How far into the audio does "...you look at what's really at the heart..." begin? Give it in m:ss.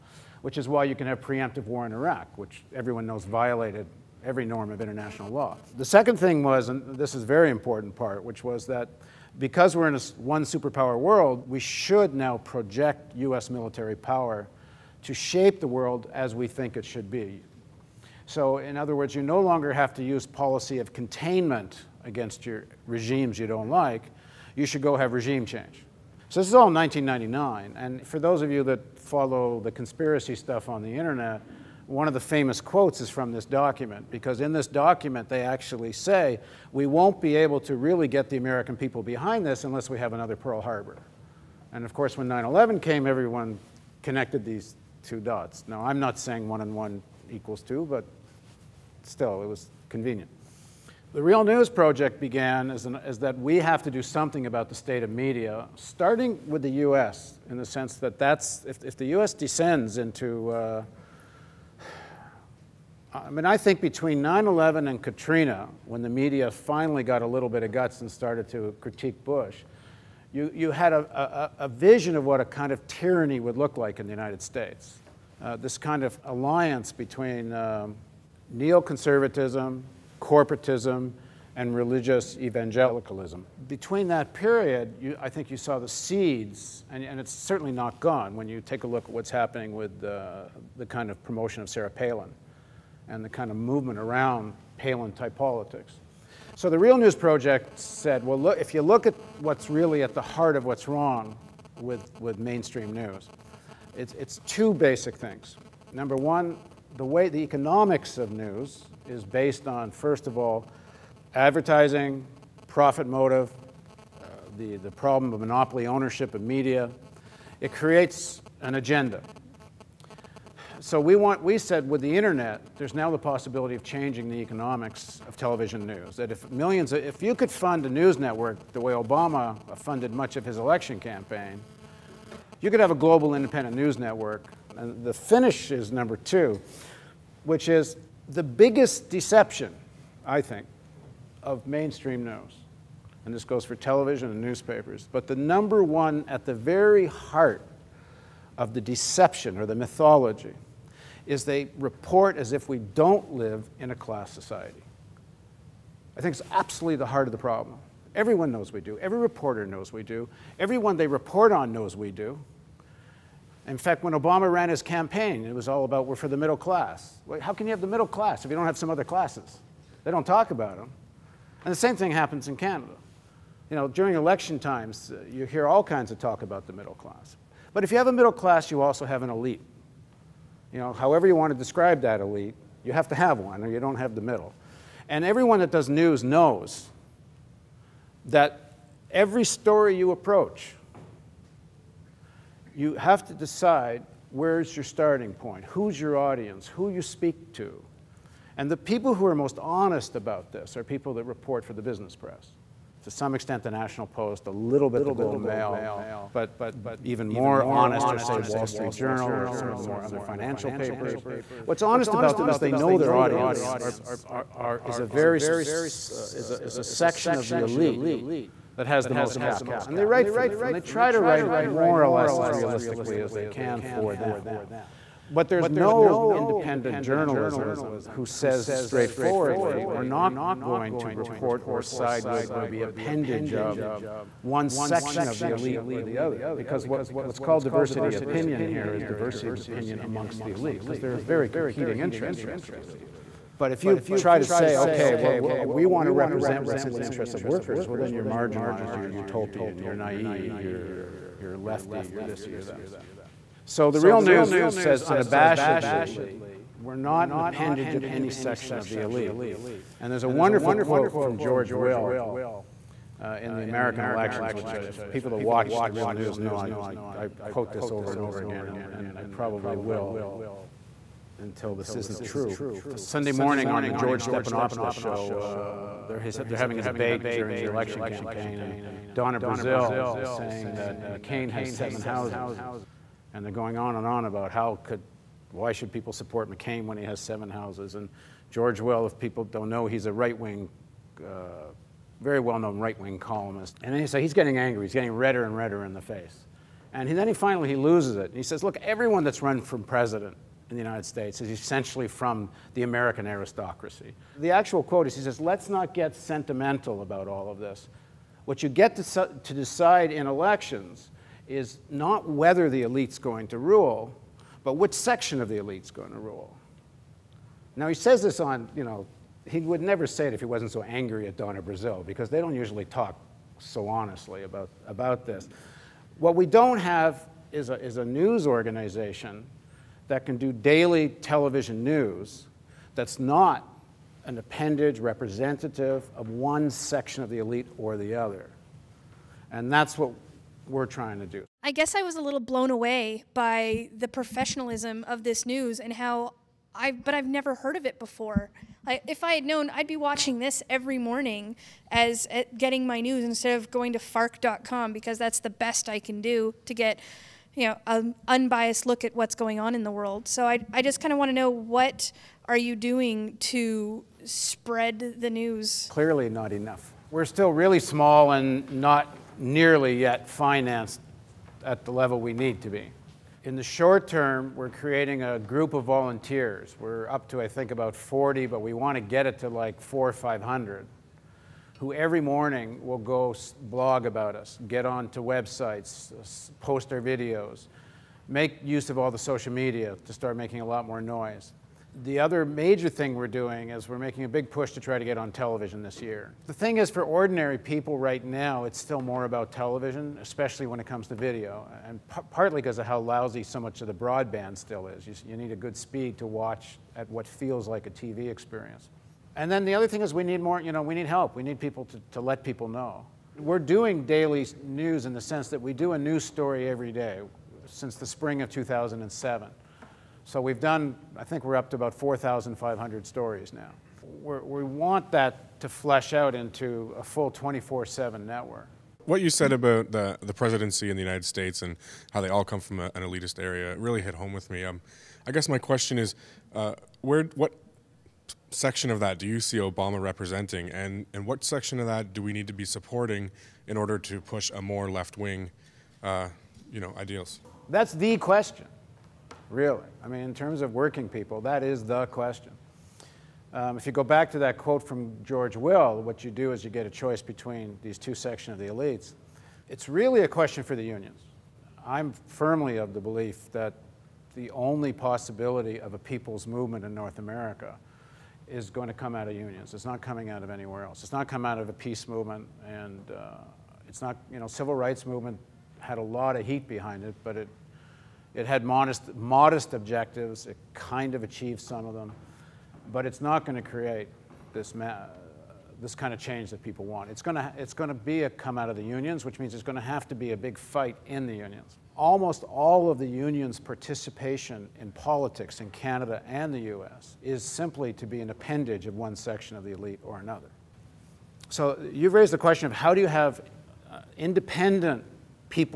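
1:38.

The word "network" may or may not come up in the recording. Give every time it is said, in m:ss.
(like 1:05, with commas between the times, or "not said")
2:08, 2:13, 7:08.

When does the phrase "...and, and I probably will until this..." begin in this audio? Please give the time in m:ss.
4:28.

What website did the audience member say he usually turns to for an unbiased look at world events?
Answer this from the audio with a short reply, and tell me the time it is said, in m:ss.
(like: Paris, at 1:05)
Fark.com, at 5:53.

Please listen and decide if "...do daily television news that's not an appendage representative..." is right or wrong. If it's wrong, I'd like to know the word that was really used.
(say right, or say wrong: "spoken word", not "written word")
right.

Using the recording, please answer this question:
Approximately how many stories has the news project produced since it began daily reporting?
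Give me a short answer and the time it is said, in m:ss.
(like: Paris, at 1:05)
4,500, at 7:01.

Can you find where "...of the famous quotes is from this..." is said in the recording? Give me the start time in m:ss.
0:32.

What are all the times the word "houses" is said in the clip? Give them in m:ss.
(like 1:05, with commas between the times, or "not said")
4:42, 4:47.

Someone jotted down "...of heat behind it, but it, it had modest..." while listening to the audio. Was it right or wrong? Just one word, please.
right.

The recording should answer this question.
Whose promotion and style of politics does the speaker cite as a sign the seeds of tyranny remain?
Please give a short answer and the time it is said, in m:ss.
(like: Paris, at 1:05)
Sarah Palin, at 1:31.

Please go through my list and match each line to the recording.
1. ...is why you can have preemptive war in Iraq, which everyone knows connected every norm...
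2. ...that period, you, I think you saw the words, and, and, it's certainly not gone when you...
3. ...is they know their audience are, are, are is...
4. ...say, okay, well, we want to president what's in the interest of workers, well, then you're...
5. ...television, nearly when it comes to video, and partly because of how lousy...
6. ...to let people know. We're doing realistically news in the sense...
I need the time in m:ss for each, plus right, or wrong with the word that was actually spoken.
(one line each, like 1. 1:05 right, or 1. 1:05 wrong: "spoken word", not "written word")
1. 0:00 wrong: "violated", not "connected"
2. 1:24 wrong: "seeds", not "words"
3. 3:32 right
4. 4:04 wrong: "represent", not "president"
5. 6:39 wrong: "especially", not "nearly"
6. 6:52 wrong: "daily", not "realistically".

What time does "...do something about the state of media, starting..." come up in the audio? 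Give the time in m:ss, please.
0:53.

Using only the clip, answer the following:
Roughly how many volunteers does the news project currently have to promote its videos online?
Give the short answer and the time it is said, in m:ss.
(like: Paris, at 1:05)
40, at 6:17.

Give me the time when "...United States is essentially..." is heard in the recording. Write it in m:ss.
5:00.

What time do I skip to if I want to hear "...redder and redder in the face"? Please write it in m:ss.
4:55.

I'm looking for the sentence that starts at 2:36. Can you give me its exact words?
I think it's absolutely the heart of the problem.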